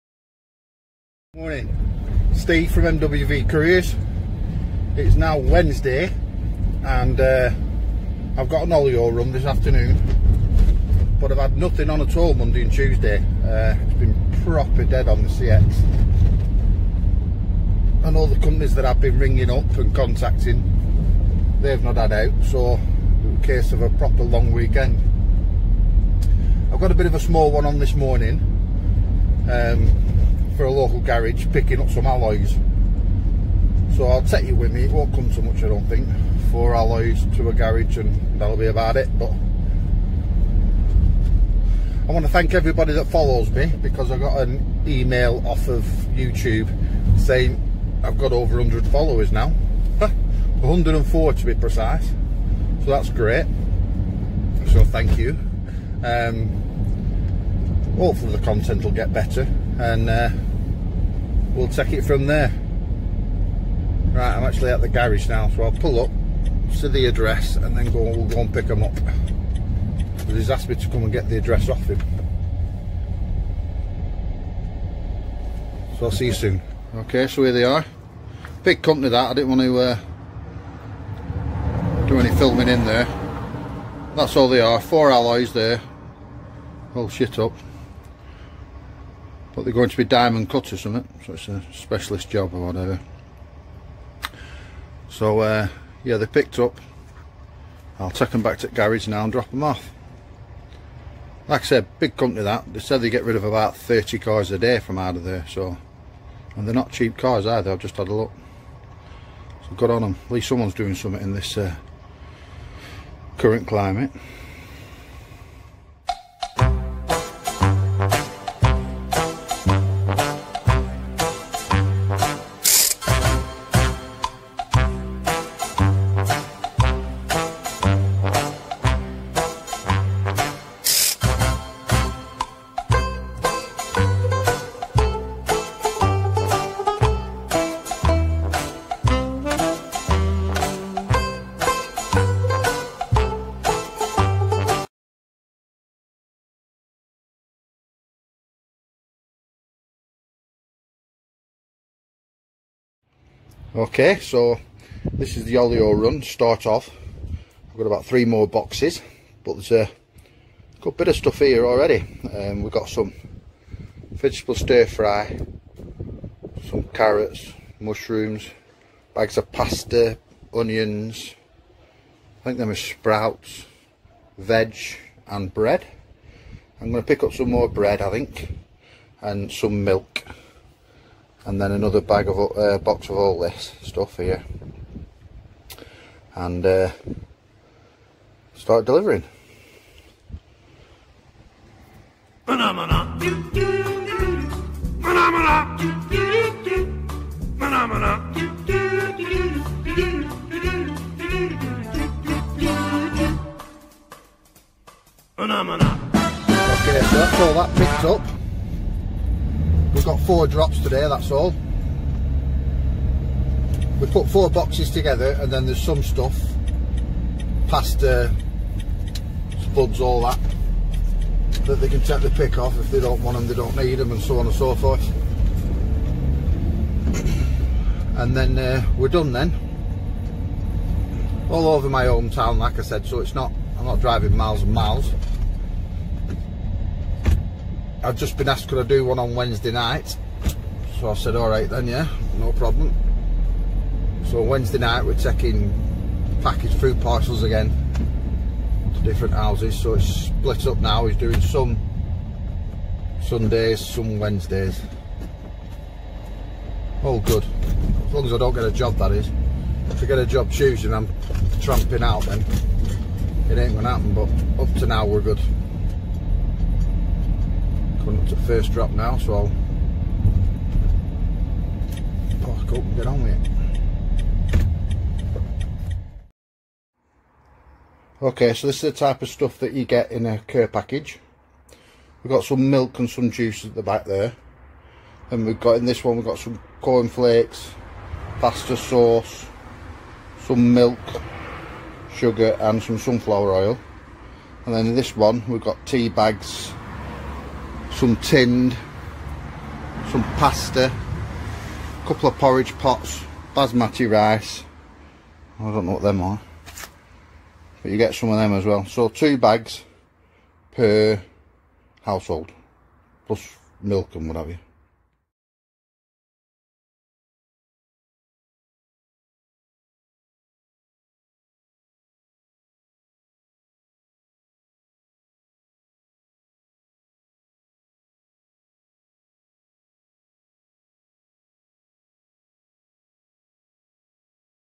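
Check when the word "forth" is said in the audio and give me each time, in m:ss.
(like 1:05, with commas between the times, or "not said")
3:44.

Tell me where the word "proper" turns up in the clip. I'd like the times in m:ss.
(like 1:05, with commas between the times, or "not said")
0:14, 0:23.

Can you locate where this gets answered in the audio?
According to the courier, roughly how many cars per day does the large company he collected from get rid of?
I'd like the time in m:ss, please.
1:43.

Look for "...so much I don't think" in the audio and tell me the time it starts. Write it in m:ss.
0:35.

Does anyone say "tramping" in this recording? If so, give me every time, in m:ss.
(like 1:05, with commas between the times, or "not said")
4:21.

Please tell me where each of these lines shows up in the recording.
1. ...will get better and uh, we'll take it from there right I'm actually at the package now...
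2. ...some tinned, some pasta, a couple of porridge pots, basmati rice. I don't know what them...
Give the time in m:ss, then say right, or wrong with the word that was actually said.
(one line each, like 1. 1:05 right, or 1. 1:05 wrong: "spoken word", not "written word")
1. 0:58 wrong: "garage", not "package"
2. 4:57 right.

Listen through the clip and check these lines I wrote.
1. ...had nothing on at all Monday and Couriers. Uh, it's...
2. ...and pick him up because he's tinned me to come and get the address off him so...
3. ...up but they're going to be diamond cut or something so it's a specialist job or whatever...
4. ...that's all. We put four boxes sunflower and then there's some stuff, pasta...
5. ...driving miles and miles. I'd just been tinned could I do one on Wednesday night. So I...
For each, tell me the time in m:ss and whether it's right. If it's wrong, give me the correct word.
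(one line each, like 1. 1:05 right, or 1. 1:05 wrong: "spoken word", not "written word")
1. 0:11 wrong: "Tuesday", not "Couriers"
2. 1:08 wrong: "asked", not "tinned"
3. 1:27 right
4. 3:31 wrong: "together", not "sunflower"
5. 3:53 wrong: "asked", not "tinned".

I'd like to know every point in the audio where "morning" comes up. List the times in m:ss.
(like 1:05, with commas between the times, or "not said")
0:01, 0:27.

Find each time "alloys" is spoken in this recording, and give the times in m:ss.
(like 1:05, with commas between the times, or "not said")
0:32, 0:36, 1:25.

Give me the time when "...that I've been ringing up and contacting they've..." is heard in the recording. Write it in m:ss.
0:18.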